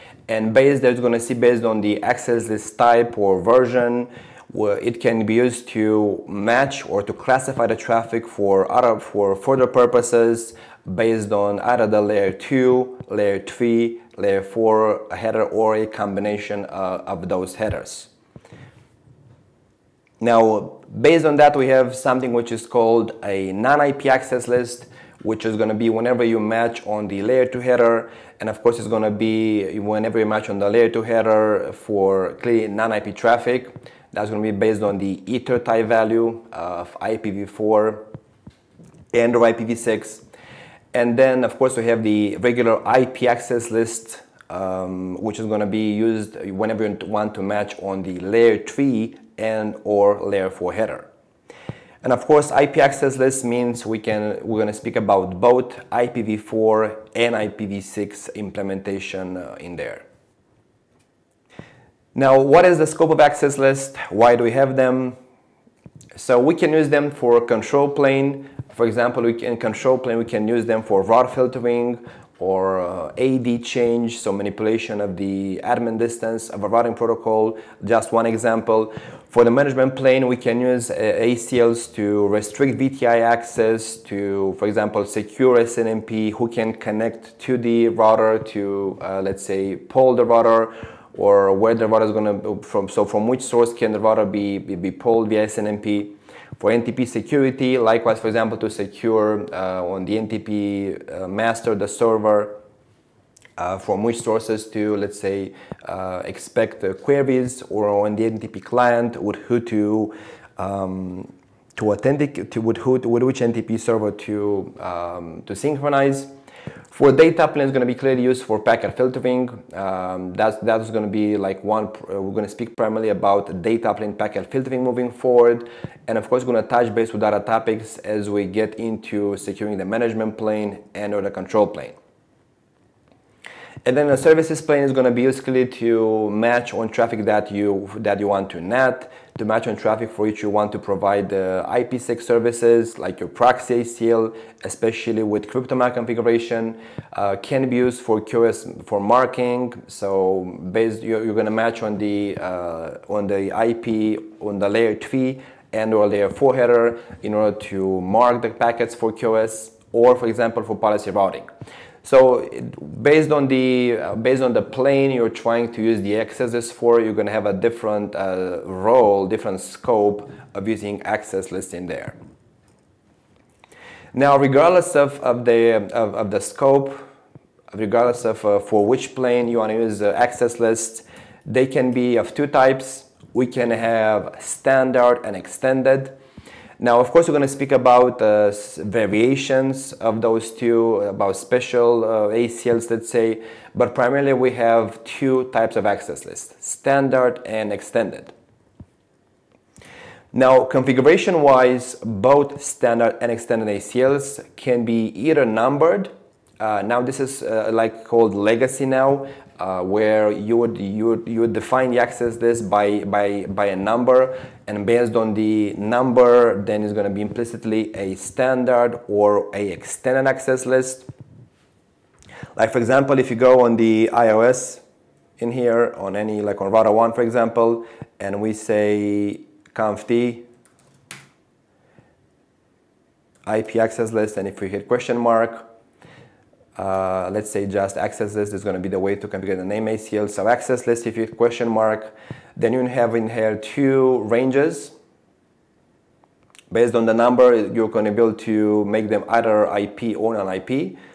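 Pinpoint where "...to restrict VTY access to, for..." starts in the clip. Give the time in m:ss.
1:21.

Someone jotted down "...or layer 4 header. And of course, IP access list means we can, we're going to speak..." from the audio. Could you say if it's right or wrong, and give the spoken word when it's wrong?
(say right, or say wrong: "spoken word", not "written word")
right.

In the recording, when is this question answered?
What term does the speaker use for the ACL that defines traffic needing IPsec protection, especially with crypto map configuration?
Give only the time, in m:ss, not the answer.
2:23.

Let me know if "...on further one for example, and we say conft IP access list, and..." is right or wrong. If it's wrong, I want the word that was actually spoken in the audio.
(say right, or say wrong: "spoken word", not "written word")
wrong: "router", not "further".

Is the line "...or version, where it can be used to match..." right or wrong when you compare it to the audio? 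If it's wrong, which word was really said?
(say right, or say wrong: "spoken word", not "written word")
right.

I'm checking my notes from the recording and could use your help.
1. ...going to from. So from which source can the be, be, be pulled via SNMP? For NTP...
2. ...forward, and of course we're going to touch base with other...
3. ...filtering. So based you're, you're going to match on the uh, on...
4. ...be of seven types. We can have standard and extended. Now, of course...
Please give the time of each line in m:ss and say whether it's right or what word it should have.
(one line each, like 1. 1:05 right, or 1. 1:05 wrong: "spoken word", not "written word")
1. 1:32 right
2. 2:05 right
3. 2:28 wrong: "marking", not "filtering"
4. 3:01 wrong: "two", not "seven".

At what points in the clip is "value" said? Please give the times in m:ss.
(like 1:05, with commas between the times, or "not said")
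0:35.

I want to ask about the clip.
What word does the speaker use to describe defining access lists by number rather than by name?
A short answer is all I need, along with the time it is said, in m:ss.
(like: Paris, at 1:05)
Legacy, at 3:28.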